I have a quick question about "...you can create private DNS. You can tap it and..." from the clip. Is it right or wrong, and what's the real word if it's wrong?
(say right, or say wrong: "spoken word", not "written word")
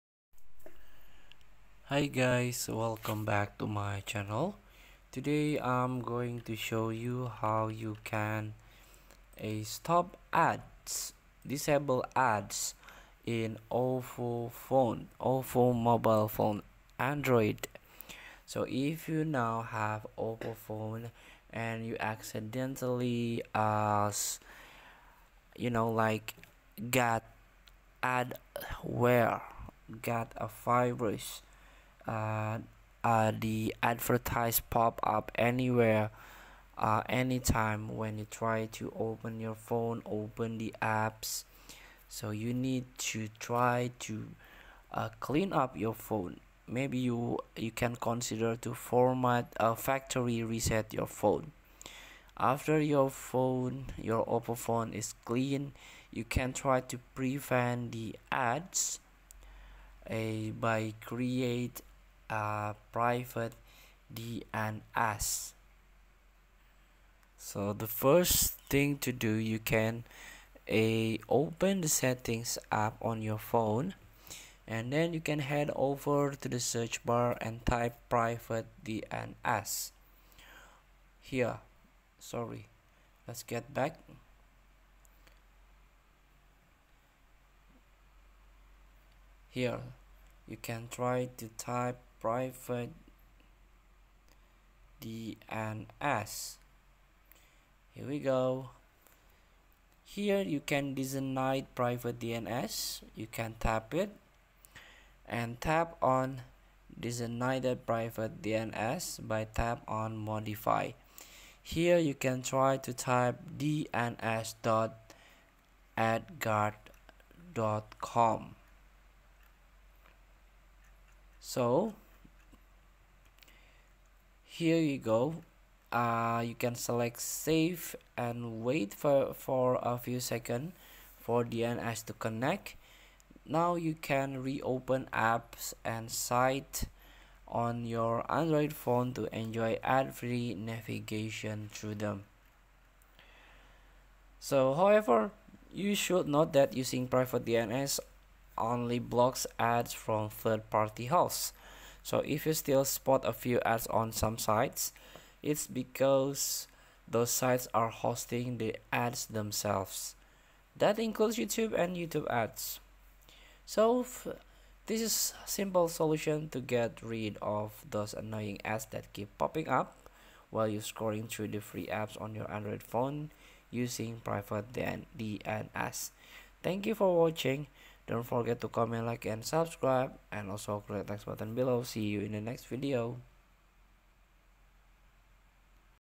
wrong: "designate", not "create".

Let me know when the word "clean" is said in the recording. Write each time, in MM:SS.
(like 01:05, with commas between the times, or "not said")
00:45, 00:55.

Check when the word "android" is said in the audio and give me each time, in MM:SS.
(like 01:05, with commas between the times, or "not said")
00:16, 02:18, 02:52.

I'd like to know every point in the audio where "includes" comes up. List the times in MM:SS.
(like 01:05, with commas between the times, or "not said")
02:40.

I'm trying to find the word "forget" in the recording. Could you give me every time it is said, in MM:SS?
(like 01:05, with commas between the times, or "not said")
02:58.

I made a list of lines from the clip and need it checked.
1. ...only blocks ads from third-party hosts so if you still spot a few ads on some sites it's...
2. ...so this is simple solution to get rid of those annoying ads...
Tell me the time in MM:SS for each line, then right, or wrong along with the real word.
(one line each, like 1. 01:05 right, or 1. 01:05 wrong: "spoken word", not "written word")
1. 02:28 right
2. 02:43 right.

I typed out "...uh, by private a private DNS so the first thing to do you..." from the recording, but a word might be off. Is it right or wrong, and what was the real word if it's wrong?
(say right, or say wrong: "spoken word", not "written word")
wrong: "create", not "private".